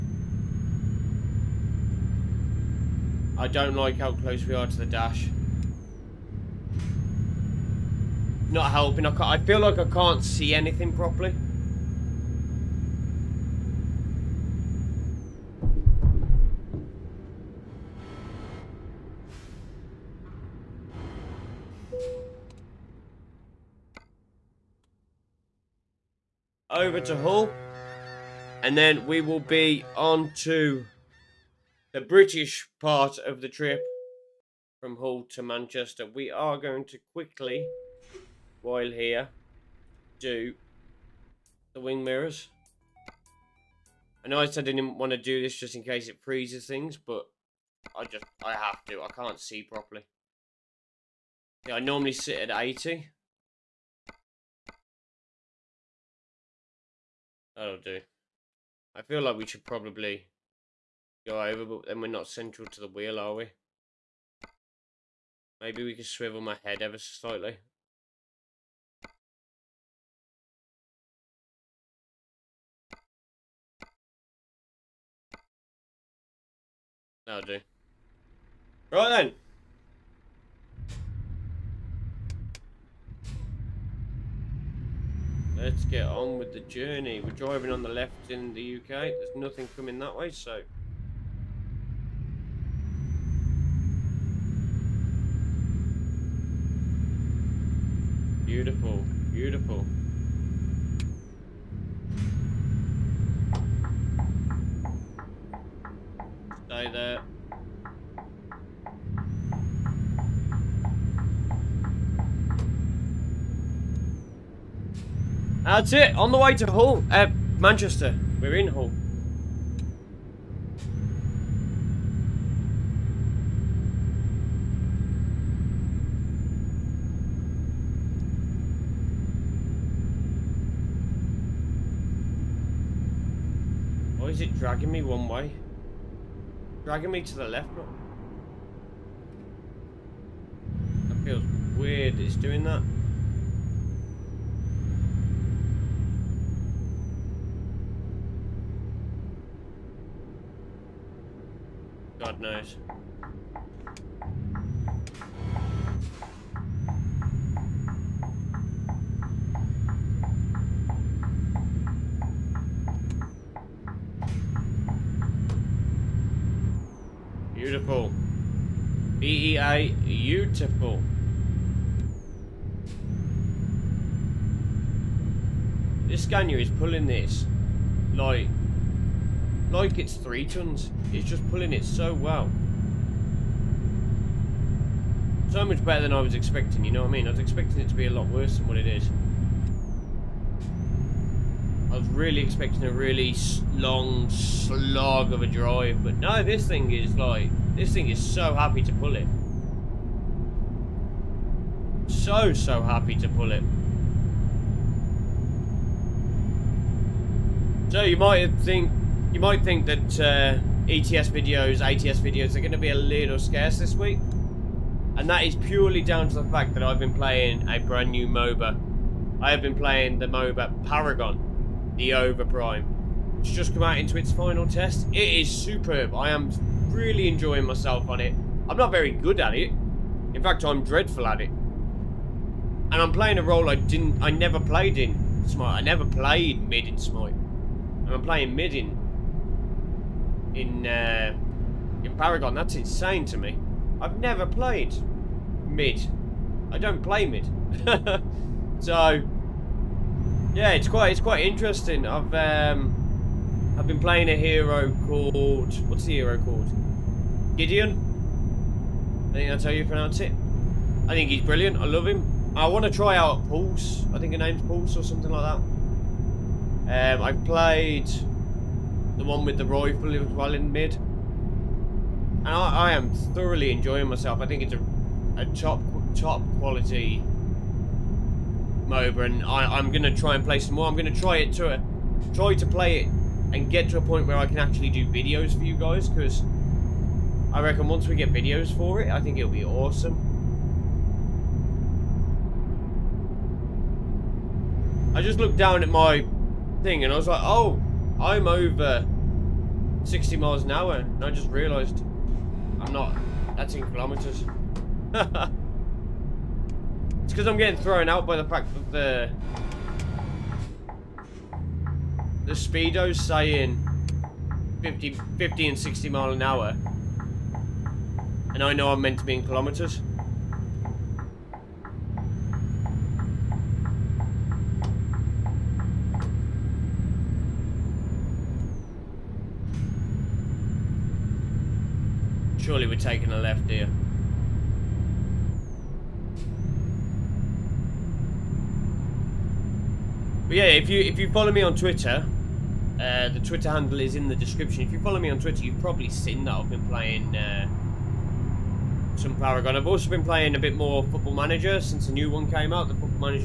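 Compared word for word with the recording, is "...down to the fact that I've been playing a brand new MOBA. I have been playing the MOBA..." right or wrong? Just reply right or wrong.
right.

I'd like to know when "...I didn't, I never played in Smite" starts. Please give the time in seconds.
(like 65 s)
233 s.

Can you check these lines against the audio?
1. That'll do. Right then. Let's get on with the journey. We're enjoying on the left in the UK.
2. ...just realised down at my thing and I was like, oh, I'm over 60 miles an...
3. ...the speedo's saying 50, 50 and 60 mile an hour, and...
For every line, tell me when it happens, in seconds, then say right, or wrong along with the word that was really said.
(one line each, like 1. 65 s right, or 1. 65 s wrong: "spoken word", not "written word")
1. 77 s wrong: "driving", not "enjoying"
2. 295 s wrong: "looked", not "realised"
3. 312 s right.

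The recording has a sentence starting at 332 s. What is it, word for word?
Surely we're taking a left here.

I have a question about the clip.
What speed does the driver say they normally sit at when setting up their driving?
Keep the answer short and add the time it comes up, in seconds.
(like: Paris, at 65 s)
80, at 52 s.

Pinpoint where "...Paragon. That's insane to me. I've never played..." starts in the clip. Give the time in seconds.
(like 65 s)
242 s.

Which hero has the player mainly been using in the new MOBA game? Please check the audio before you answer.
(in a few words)
Gideon.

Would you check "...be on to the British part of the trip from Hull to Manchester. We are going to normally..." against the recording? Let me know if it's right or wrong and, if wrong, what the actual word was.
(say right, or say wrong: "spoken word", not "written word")
wrong: "quickly", not "normally".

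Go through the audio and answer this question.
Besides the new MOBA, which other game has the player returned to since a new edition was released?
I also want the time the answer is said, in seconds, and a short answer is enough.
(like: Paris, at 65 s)
Football Manager, at 351 s.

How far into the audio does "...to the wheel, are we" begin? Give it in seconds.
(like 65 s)
62 s.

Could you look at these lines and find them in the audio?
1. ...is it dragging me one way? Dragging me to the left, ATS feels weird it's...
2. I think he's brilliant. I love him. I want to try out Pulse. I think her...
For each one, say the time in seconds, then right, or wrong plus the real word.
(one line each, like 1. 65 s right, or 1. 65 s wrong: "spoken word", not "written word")
1. 134 s wrong: "That", not "ATS"
2. 261 s right.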